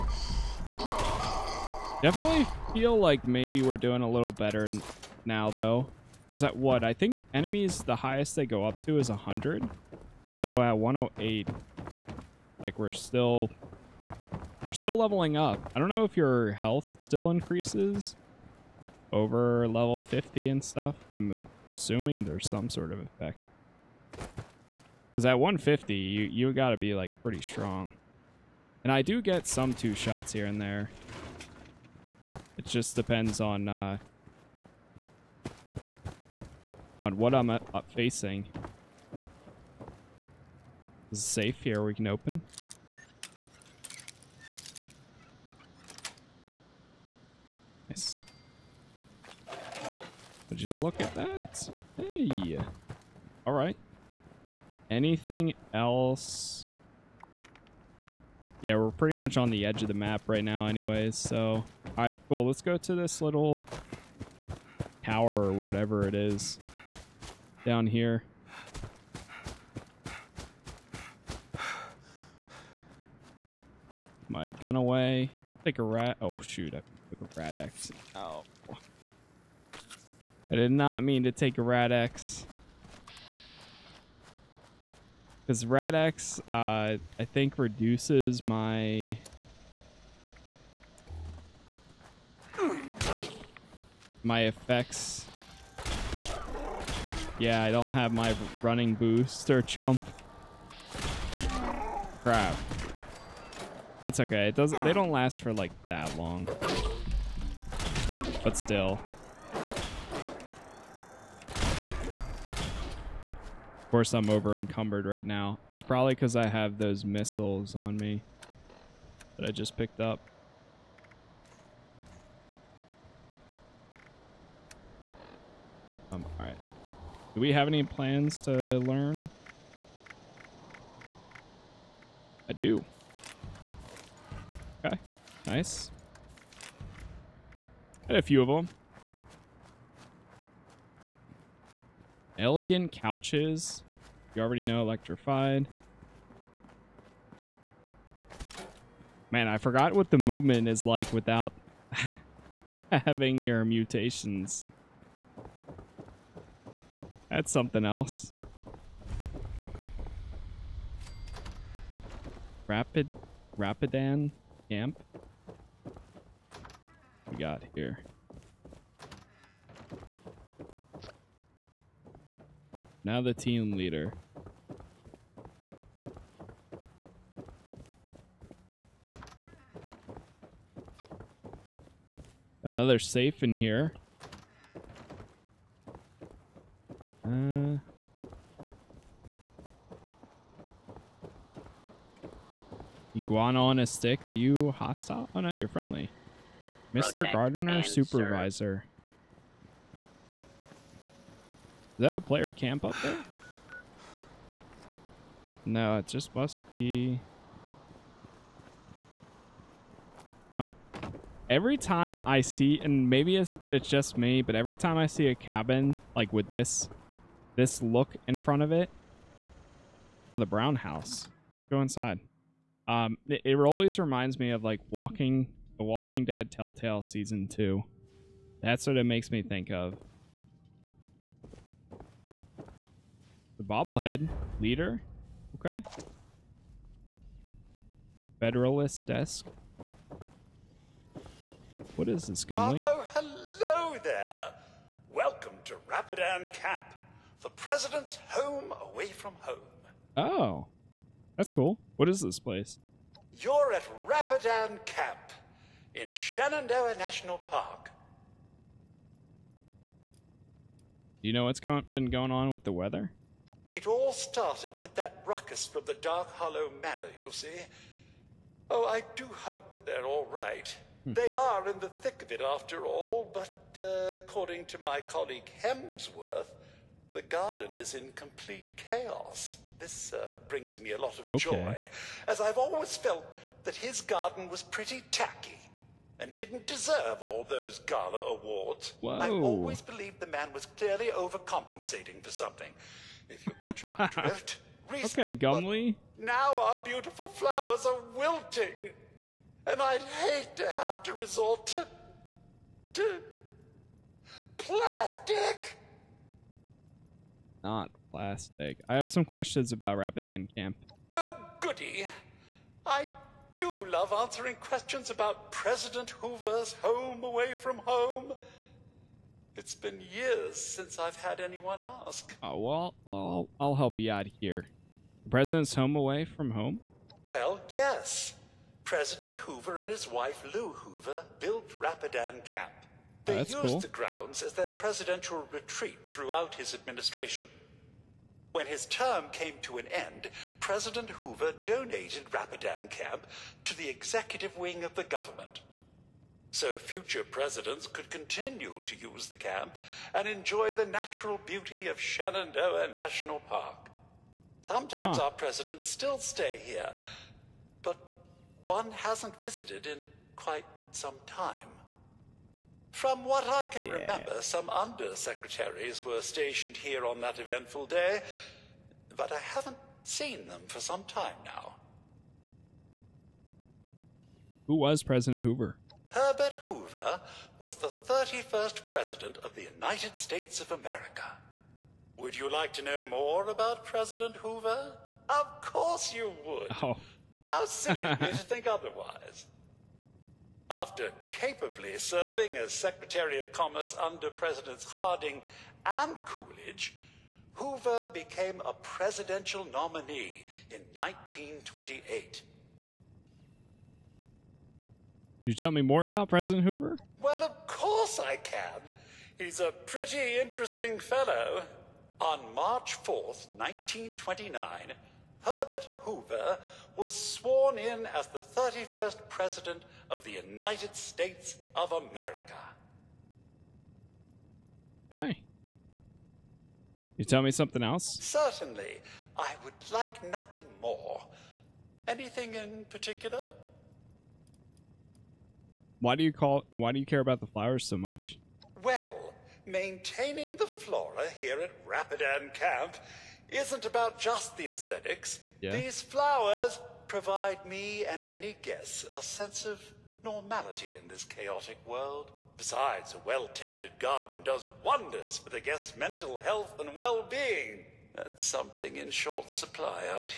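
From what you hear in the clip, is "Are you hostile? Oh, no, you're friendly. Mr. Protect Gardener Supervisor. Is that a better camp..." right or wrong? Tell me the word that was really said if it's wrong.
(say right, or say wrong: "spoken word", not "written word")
wrong: "player", not "better".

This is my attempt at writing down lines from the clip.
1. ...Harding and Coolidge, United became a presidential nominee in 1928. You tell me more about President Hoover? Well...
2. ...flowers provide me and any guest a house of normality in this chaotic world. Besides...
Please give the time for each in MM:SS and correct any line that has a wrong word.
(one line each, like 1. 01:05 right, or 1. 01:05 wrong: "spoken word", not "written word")
1. 06:34 wrong: "Hoover", not "United"
2. 07:26 wrong: "sense", not "house".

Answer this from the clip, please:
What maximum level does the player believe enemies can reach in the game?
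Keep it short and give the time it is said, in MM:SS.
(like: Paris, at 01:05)
100, at 00:09.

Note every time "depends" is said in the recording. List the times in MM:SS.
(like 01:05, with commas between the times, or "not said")
00:32.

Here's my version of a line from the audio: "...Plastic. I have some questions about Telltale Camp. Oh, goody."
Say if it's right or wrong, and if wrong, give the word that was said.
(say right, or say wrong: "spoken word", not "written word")
wrong: "Rapidan", not "Telltale".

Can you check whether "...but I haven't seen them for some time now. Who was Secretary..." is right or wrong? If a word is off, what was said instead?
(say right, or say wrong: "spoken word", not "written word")
wrong: "President", not "Secretary".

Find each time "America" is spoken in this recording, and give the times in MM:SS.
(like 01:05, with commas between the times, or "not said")
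06:20, 07:01.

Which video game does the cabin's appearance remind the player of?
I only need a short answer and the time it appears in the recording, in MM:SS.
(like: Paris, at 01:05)
Walking Dead Telltale season two, at 03:45.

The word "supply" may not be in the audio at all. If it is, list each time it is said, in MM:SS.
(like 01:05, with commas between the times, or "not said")
07:39.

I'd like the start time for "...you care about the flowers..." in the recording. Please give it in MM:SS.
07:16.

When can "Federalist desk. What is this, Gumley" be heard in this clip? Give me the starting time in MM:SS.
03:58.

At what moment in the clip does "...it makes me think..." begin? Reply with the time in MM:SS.
03:48.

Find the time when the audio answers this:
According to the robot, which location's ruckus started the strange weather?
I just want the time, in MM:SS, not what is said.
04:25.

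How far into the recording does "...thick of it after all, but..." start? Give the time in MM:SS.
04:32.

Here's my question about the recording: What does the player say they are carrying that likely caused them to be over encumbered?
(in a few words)
Missiles.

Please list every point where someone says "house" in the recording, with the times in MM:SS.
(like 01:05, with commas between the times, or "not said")
03:40.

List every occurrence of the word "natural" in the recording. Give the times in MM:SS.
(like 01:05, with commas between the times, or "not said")
05:50.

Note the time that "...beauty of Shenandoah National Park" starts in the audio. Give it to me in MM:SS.
05:51.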